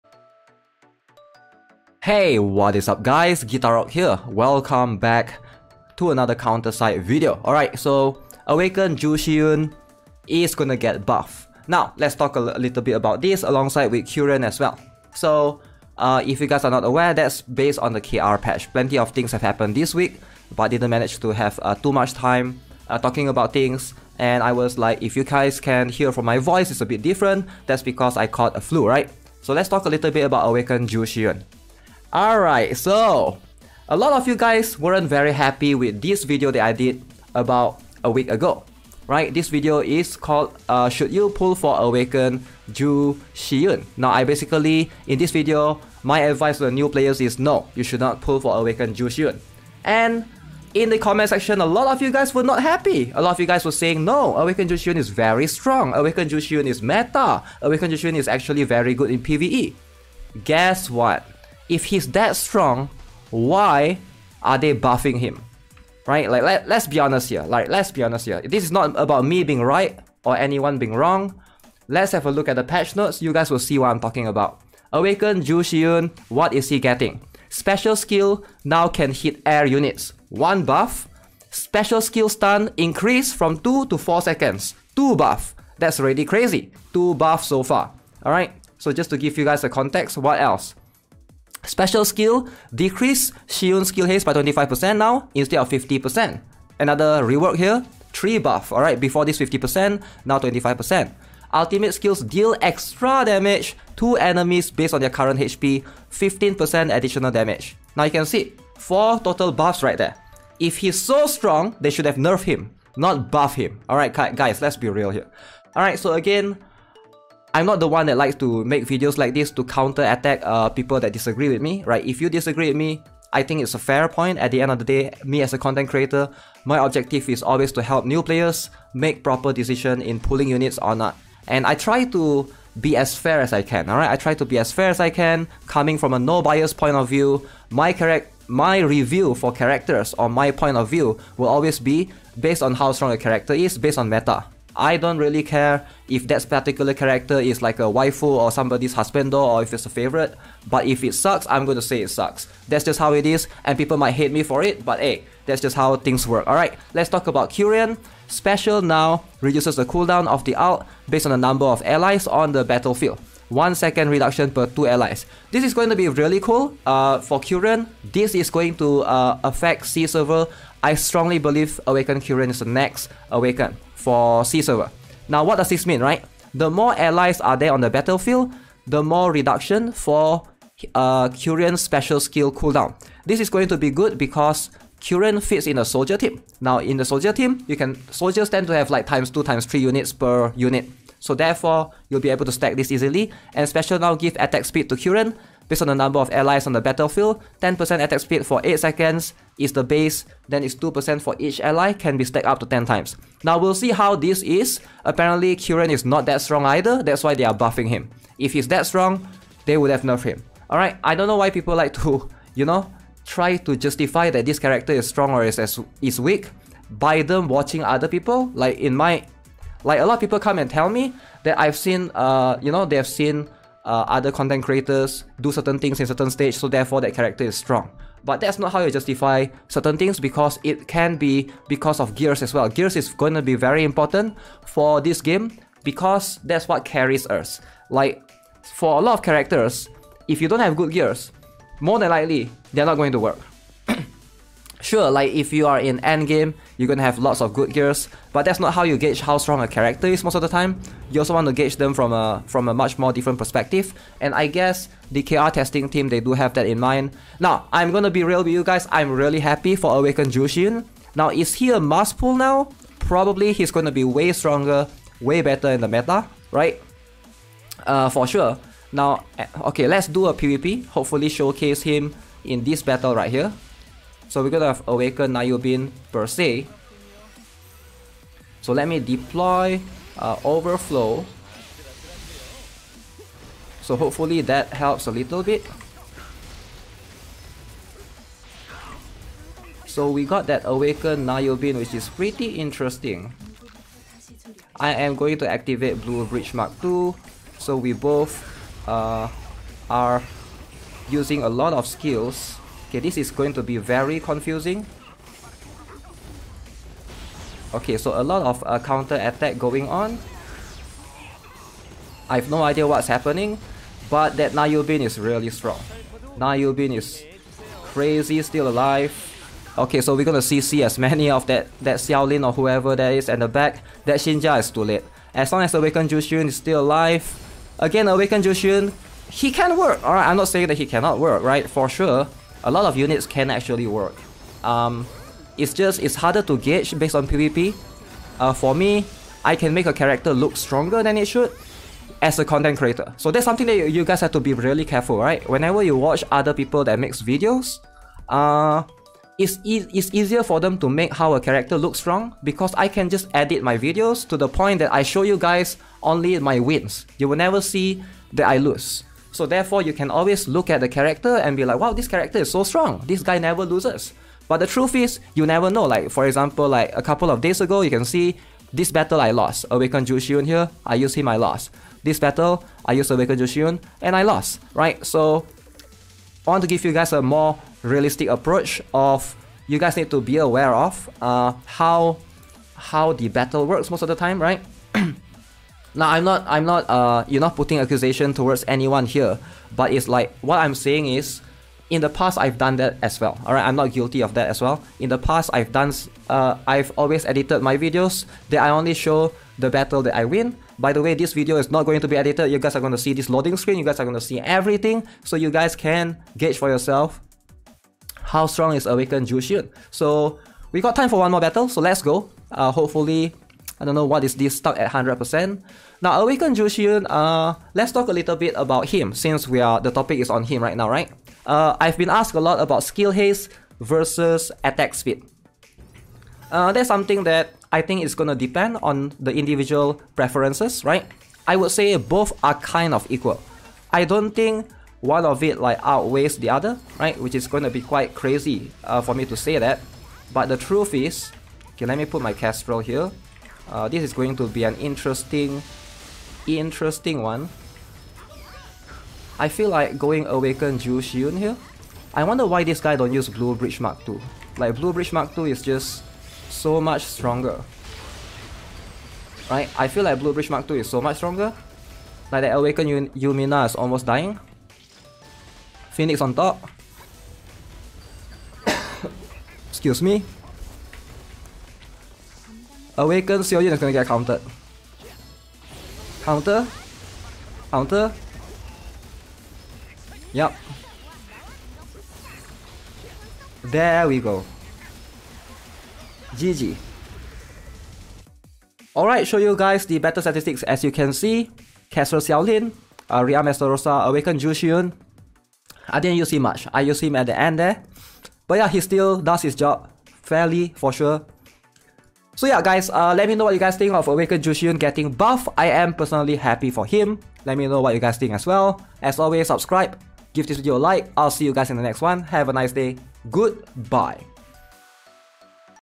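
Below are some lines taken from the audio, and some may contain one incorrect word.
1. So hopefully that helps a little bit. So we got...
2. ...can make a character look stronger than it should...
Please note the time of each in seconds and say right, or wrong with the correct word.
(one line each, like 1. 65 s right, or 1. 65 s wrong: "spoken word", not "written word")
1. 283 s right
2. 339 s right.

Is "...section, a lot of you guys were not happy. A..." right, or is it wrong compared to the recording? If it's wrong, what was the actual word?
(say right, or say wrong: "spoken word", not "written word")
right.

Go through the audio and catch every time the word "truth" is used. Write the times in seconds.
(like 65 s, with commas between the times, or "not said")
364 s, 440 s.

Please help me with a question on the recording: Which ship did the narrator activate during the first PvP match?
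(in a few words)
Blue Bridge Mark II.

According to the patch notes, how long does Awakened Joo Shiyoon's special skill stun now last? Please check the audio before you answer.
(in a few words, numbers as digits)
4 seconds.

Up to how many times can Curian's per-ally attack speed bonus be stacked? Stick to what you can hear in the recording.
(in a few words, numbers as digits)
10.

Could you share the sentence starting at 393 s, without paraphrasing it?
All right, I'm not guilty of that as well.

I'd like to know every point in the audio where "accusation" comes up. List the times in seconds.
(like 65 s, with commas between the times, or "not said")
387 s.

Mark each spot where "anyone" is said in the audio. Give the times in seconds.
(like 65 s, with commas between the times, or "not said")
70 s, 388 s.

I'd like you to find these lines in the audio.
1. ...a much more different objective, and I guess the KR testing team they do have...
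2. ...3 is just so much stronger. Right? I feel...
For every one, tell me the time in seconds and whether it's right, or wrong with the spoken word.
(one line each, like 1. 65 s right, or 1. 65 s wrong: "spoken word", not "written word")
1. 252 s wrong: "perspective", not "objective"
2. 455 s wrong: "2", not "3".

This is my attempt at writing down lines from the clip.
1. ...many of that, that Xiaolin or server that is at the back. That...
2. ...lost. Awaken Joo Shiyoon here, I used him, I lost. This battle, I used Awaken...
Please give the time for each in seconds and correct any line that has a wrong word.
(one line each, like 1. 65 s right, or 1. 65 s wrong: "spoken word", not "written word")
1. 320 s wrong: "whoever", not "server"
2. 369 s right.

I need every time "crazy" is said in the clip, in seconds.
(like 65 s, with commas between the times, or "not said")
86 s, 317 s, 438 s.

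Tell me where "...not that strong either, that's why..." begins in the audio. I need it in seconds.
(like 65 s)
206 s.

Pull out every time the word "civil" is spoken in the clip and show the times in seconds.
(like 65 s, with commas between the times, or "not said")
not said.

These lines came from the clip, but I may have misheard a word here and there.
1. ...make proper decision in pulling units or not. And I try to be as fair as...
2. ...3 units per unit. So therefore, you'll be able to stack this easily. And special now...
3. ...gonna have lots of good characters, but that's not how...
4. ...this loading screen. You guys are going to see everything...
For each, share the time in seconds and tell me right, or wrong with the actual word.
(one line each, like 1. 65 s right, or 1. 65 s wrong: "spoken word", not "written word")
1. 128 s right
2. 189 s right
3. 246 s wrong: "gears", not "characters"
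4. 403 s right.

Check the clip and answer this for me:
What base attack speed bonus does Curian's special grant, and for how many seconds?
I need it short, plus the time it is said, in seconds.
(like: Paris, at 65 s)
10% for 8 seconds, at 197 s.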